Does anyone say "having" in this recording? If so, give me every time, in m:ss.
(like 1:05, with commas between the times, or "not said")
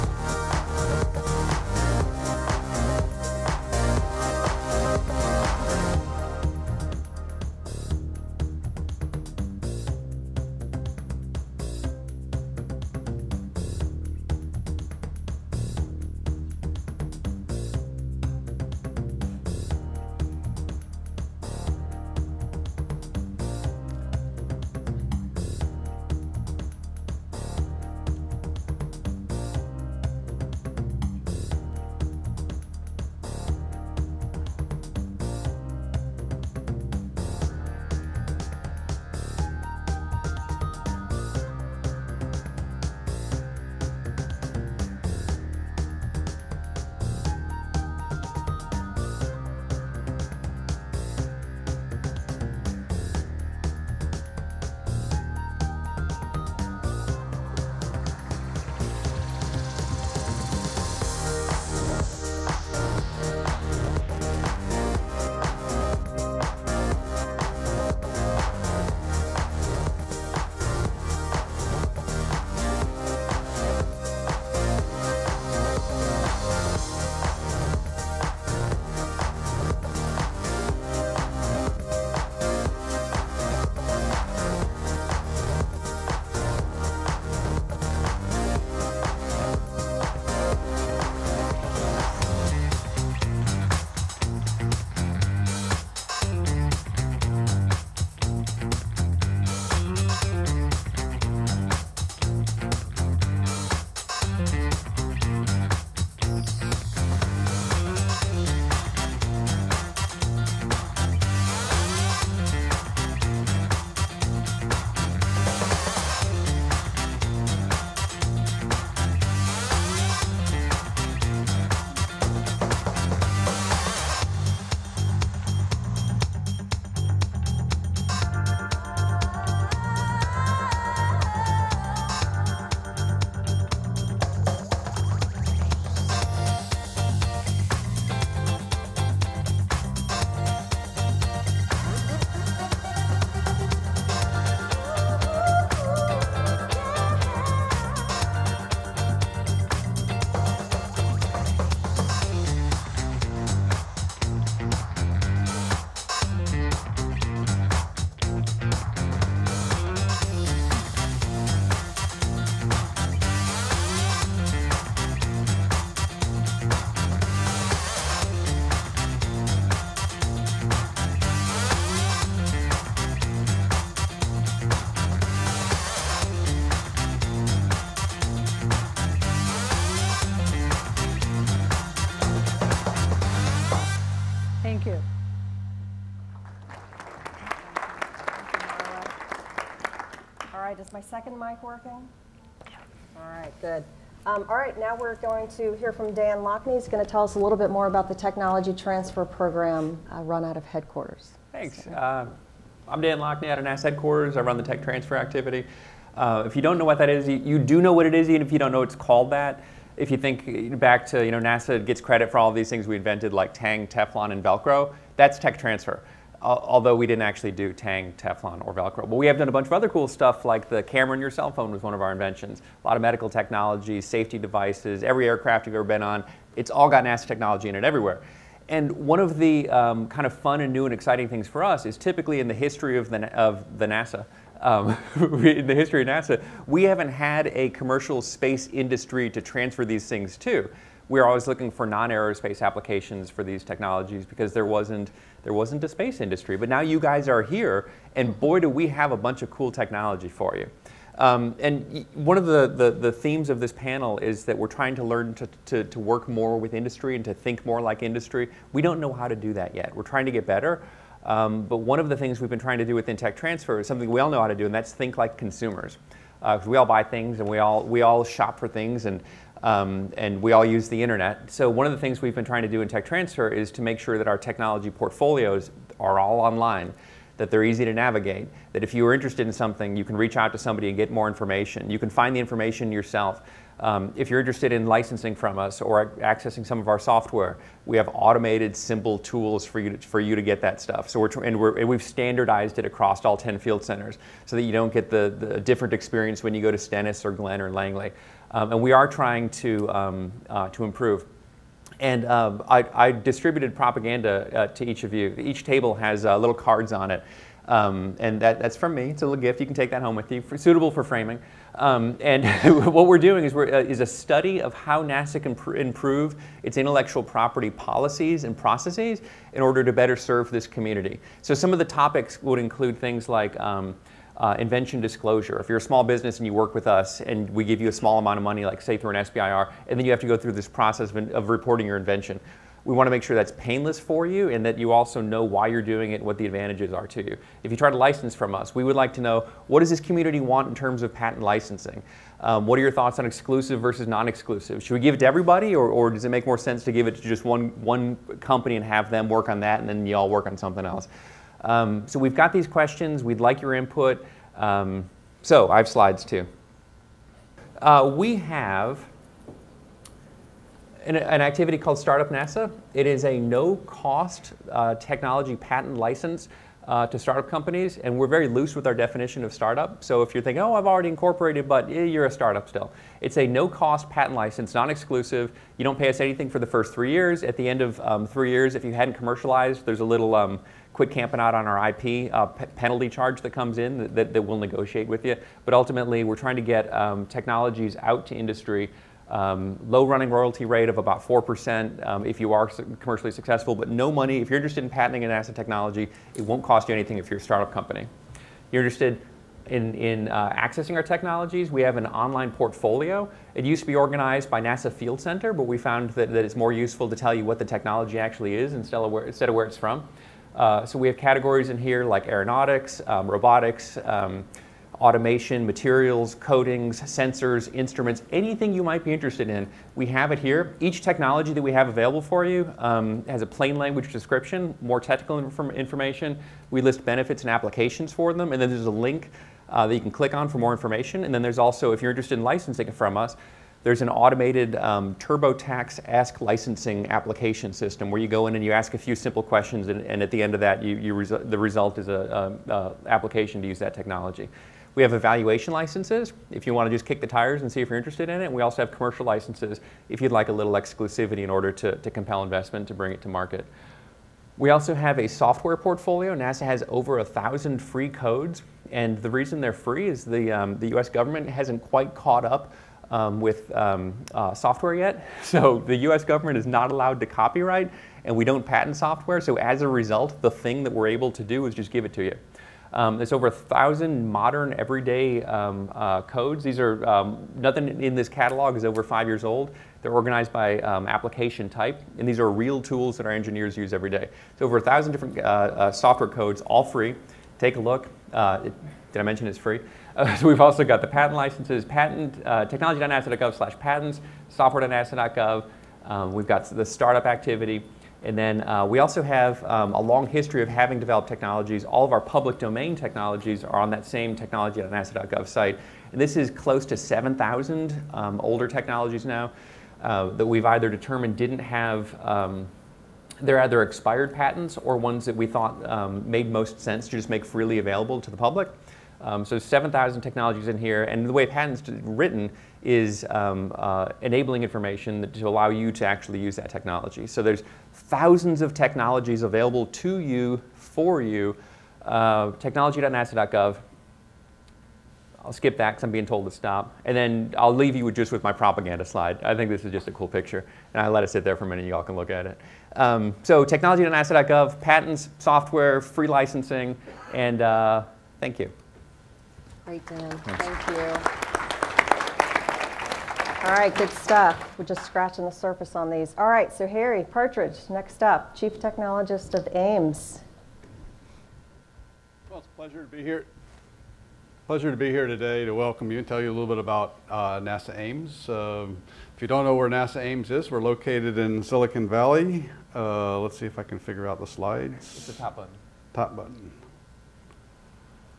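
8:20.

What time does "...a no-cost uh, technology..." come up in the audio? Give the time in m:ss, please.
6:03.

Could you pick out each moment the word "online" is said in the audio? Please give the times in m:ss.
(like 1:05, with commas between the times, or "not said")
4:36, 6:42.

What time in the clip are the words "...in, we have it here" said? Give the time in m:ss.
6:59.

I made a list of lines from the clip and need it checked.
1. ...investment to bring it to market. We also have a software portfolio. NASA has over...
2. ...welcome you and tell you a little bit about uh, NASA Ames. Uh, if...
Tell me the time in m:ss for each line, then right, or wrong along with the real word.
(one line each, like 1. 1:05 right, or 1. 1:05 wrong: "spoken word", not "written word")
1. 7:32 right
2. 9:25 right.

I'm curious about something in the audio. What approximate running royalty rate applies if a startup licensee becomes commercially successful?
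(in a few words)
4%.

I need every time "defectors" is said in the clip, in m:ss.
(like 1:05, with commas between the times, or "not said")
not said.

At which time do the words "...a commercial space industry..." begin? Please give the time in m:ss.
3:57.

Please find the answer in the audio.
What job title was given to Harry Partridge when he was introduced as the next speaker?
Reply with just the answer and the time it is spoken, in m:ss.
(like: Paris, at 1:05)
Chief Technologist, at 9:18.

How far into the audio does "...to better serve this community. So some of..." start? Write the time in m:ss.
5:19.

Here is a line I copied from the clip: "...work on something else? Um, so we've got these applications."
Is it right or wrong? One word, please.
wrong.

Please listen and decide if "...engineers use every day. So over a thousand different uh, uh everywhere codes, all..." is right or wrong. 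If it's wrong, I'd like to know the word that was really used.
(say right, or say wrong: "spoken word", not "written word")
wrong: "software", not "everywhere".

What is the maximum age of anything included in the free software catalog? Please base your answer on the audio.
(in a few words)
5 years.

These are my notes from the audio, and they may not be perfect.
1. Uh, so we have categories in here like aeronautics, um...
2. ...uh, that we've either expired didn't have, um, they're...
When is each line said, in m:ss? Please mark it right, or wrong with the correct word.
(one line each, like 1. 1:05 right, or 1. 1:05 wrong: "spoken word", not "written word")
1. 6:50 right
2. 8:30 wrong: "determined", not "expired".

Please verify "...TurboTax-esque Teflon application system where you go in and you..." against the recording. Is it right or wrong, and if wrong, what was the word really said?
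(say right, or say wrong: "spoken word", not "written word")
wrong: "Licensing", not "Teflon".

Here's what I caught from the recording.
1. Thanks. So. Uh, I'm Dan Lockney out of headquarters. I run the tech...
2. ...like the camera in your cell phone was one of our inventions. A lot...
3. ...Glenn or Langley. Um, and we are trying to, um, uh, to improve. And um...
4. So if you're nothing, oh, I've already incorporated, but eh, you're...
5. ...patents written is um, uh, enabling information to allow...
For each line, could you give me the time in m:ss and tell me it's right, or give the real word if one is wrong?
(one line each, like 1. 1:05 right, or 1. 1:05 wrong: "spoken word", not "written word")
1. 3:21 right
2. 3:40 right
3. 4:57 right
4. 6:10 wrong: "thinking", not "nothing"
5. 8:41 right.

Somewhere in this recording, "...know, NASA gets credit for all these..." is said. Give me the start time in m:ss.
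3:31.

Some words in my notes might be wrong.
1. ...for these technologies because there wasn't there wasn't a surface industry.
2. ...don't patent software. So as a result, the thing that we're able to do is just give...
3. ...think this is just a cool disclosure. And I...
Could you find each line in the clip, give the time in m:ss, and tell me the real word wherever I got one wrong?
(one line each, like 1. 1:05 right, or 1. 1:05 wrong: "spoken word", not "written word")
1. 4:03 wrong: "space", not "surface"
2. 7:48 right
3. 8:59 wrong: "picture", not "disclosure".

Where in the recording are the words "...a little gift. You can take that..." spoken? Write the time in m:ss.
5:09.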